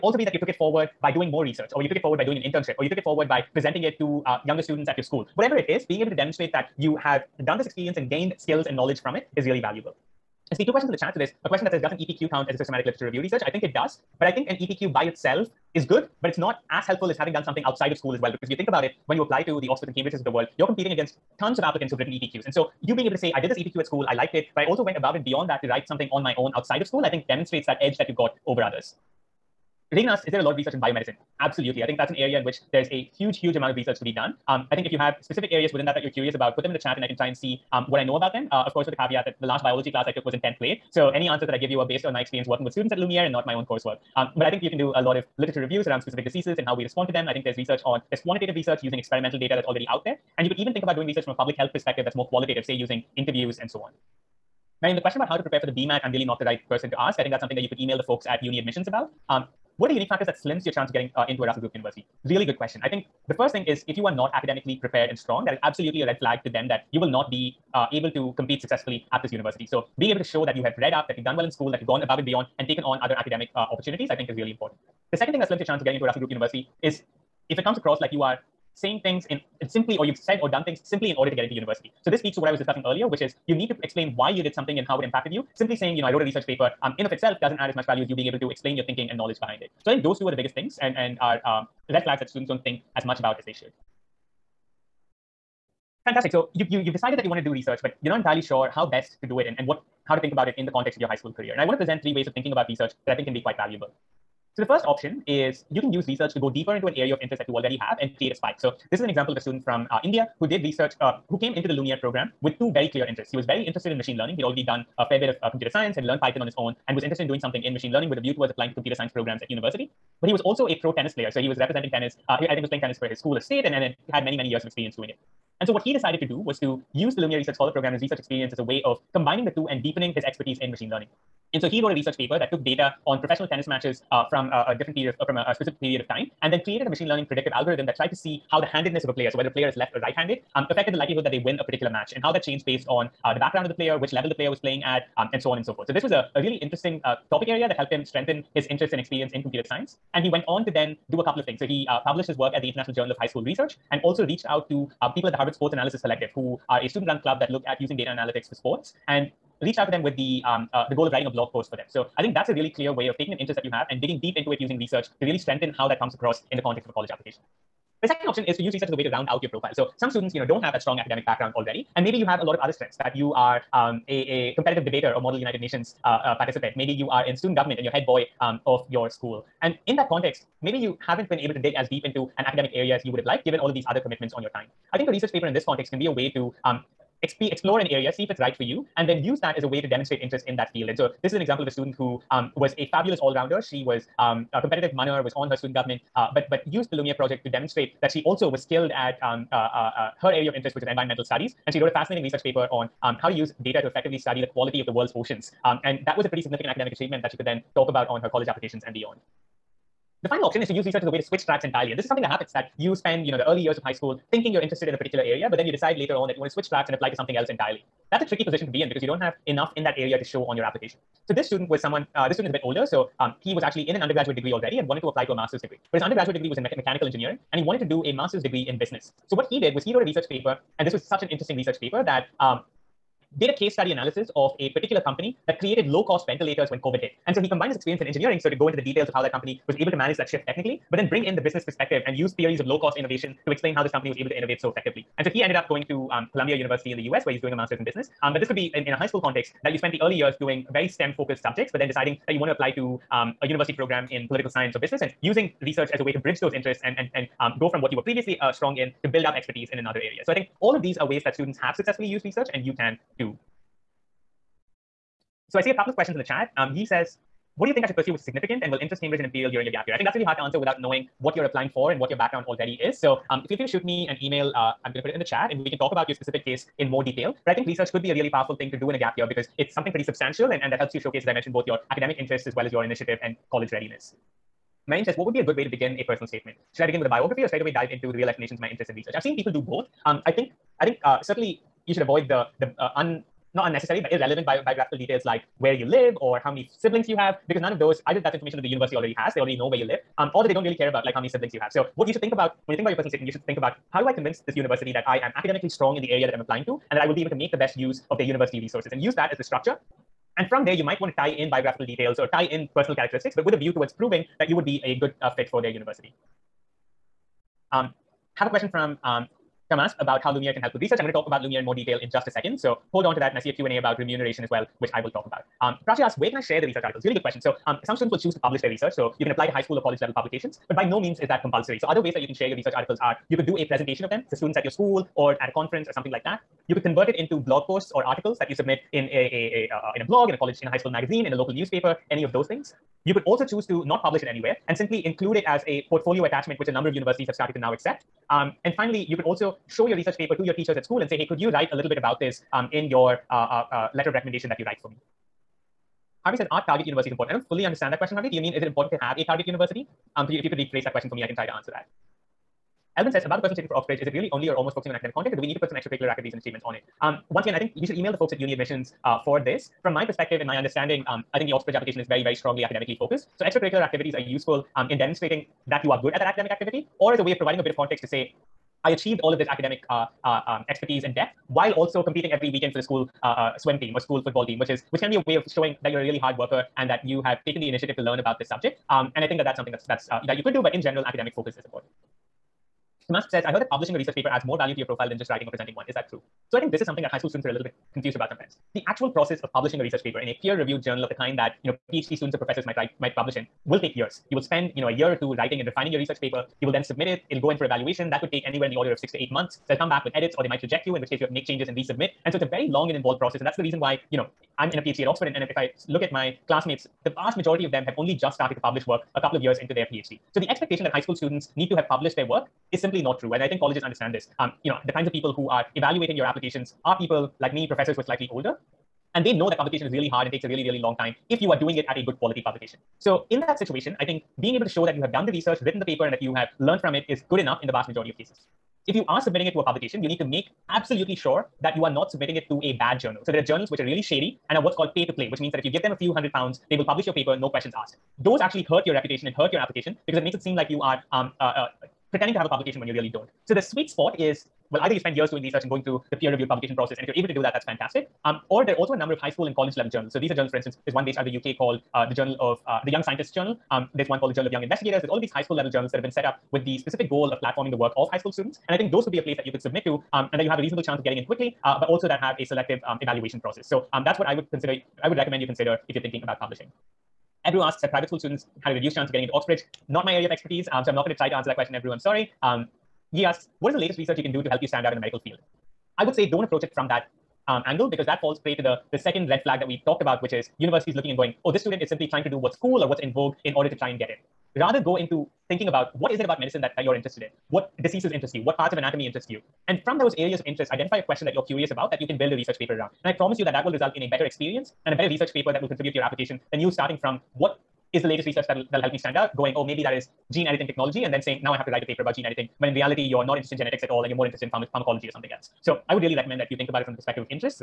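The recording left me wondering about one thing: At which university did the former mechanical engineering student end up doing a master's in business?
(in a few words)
Columbia University.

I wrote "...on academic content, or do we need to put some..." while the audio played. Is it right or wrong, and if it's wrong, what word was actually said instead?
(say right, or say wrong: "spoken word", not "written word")
right.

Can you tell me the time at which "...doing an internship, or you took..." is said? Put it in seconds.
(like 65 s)
2 s.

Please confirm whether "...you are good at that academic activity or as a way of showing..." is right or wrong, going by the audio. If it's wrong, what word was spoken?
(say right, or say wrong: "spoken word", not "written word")
wrong: "providing", not "showing".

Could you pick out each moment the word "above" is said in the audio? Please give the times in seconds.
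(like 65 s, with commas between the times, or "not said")
24 s, 72 s.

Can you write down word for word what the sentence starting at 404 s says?
You will spend you know a year or two writing and refining your research paper.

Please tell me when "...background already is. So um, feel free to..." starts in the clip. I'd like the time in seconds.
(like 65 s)
272 s.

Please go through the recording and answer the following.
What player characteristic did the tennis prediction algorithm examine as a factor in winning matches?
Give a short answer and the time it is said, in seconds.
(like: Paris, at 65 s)
handedness, at 138 s.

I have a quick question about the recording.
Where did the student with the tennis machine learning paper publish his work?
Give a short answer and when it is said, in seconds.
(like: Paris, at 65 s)
International Journal of High School Research, at 152 s.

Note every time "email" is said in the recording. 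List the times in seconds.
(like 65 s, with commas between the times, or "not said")
57 s, 274 s, 367 s.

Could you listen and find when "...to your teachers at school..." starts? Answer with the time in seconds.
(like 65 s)
350 s.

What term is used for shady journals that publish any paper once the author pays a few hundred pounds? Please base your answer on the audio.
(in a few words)
pay to play.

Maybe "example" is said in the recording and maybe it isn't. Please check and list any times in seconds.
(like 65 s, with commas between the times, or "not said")
109 s, 191 s.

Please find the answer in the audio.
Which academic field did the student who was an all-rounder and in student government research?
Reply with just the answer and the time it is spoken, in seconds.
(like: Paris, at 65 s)
environmental studies, at 200 s.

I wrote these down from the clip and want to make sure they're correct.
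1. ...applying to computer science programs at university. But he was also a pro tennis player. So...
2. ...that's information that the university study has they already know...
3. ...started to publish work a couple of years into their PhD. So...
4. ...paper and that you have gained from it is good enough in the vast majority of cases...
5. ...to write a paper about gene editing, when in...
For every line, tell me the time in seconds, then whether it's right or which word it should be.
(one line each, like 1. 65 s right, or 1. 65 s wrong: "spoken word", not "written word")
1. 118 s right
2. 298 s wrong: "already", not "study"
3. 418 s right
4. 435 s wrong: "learned", not "gained"
5. 511 s right.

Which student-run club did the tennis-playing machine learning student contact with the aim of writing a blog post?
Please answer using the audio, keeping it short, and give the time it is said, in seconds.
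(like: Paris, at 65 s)
Harvard Sports Analysis Collective, at 155 s.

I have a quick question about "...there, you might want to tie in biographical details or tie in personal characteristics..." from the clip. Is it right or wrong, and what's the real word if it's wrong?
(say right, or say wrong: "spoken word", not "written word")
right.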